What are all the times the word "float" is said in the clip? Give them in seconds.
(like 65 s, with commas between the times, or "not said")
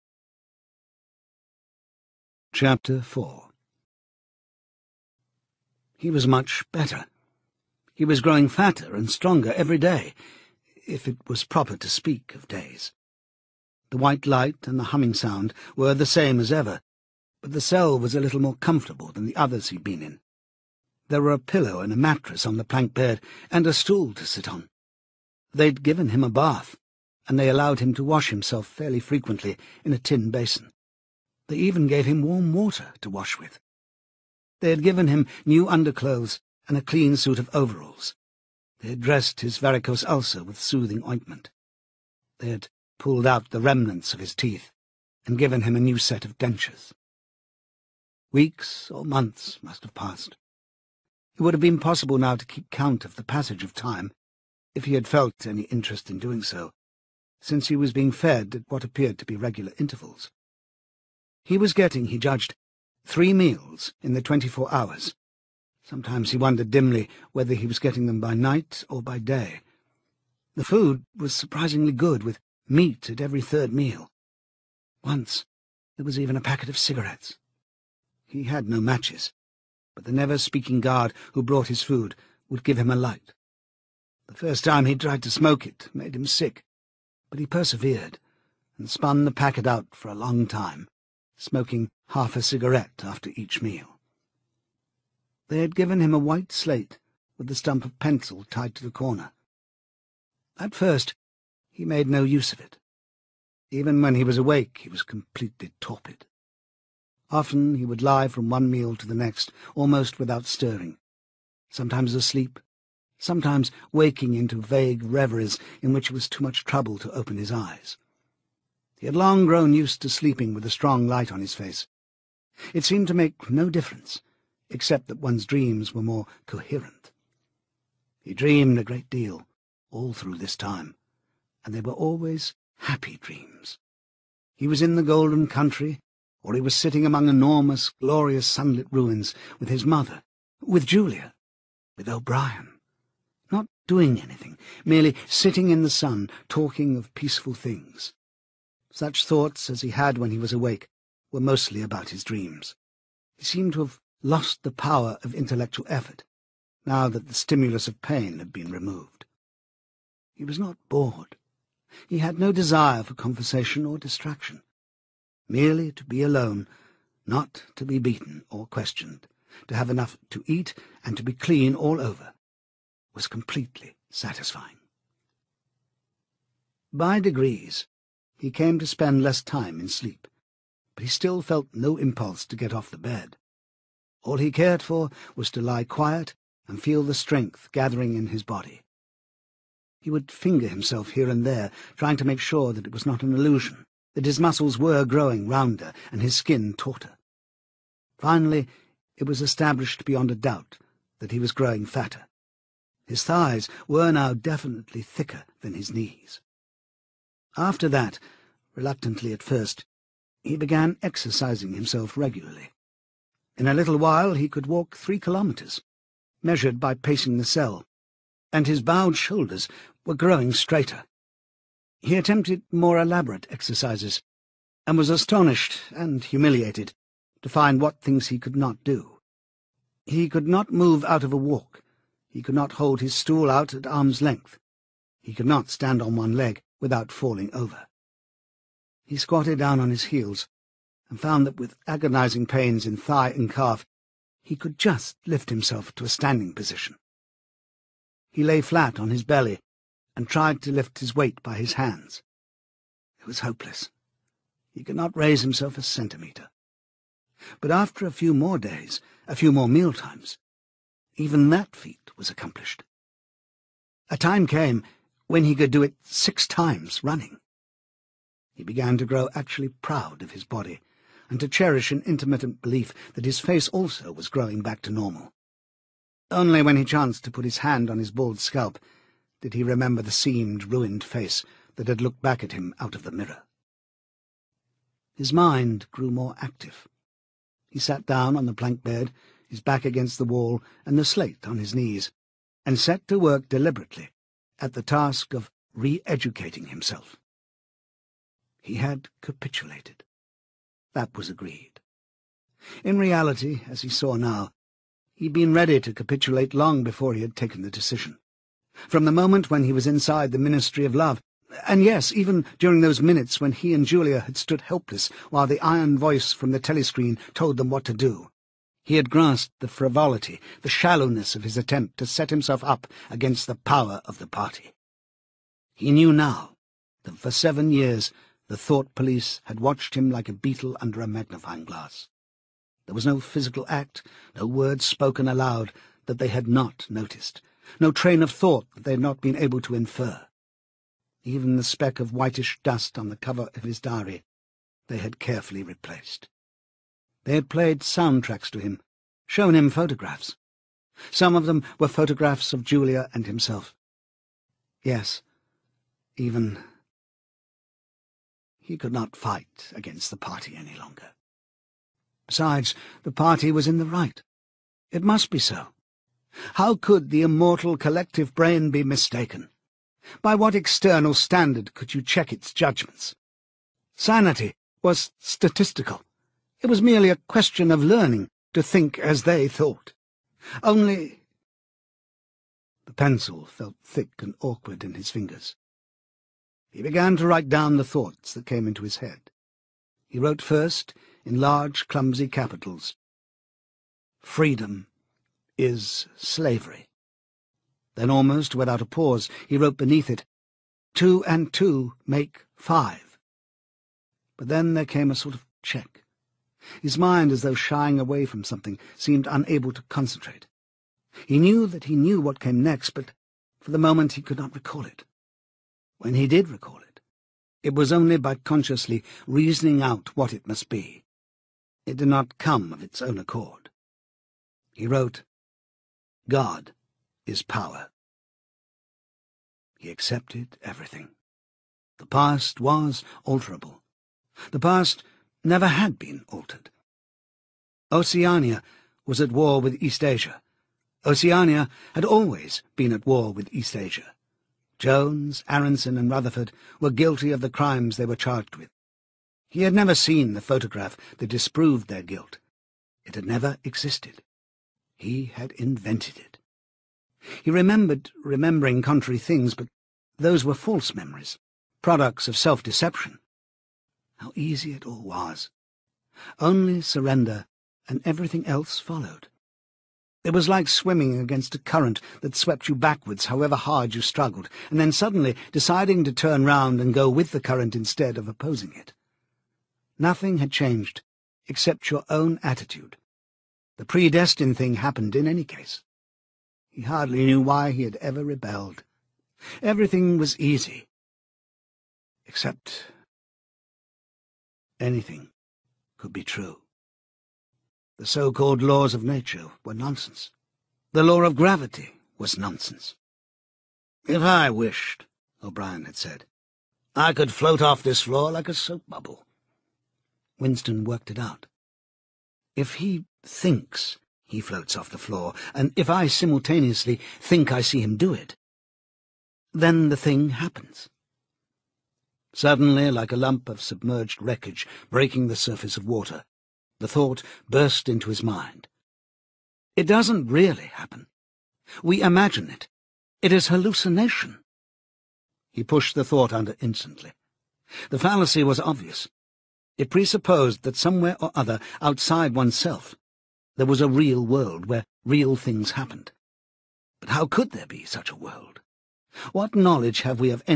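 507 s, 514 s.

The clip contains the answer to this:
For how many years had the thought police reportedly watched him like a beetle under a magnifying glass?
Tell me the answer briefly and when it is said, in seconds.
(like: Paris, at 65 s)
7, at 327 s.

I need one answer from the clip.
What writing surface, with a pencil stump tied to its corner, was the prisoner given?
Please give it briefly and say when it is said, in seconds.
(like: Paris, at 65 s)
white slate, at 96 s.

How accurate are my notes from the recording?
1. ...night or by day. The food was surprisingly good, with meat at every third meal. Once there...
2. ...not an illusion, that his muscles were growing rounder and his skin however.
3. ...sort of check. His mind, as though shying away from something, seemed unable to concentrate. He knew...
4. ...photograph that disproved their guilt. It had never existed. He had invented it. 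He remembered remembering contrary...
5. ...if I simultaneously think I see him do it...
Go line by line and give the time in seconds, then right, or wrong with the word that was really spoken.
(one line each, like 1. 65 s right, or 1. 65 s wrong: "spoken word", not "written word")
1. 68 s right
2. 193 s wrong: "tauter", not "however"
3. 405 s right
4. 450 s right
5. 515 s right.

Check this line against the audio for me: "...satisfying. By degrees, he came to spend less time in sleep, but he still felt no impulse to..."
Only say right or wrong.
right.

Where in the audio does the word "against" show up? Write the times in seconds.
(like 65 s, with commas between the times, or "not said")
289 s, 323 s, 359 s, 471 s.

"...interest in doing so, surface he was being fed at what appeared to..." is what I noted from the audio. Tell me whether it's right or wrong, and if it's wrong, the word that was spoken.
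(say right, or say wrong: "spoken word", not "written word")
wrong: "since", not "surface".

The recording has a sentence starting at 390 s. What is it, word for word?
He wrote first, in large, clumsy capitals, Freedom is slavery.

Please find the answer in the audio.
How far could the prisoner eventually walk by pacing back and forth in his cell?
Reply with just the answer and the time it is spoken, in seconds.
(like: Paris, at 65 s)
3 kilometres, at 214 s.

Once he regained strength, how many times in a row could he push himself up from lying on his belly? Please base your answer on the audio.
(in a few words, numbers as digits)
6.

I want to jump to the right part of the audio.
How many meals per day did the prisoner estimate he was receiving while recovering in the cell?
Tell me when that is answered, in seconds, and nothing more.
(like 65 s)
63 s.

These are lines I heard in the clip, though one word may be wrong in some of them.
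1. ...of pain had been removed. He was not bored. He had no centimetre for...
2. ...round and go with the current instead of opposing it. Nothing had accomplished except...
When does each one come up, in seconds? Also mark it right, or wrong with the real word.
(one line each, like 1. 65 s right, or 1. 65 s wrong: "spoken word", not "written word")
1. 157 s wrong: "desire", not "centimetre"
2. 476 s wrong: "changed", not "accomplished".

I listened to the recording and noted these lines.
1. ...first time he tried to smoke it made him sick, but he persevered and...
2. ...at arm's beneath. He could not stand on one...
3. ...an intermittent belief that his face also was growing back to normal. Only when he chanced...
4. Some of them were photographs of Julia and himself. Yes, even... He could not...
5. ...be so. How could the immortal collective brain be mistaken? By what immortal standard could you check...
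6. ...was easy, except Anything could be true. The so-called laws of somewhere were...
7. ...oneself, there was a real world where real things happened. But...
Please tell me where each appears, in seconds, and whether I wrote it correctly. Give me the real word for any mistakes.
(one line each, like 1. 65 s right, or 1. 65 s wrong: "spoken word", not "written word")
1. 84 s right
2. 233 s wrong: "length", not "beneath"
3. 271 s right
4. 351 s right
5. 365 s wrong: "external", not "immortal"
6. 490 s wrong: "nature", not "somewhere"
7. 542 s right.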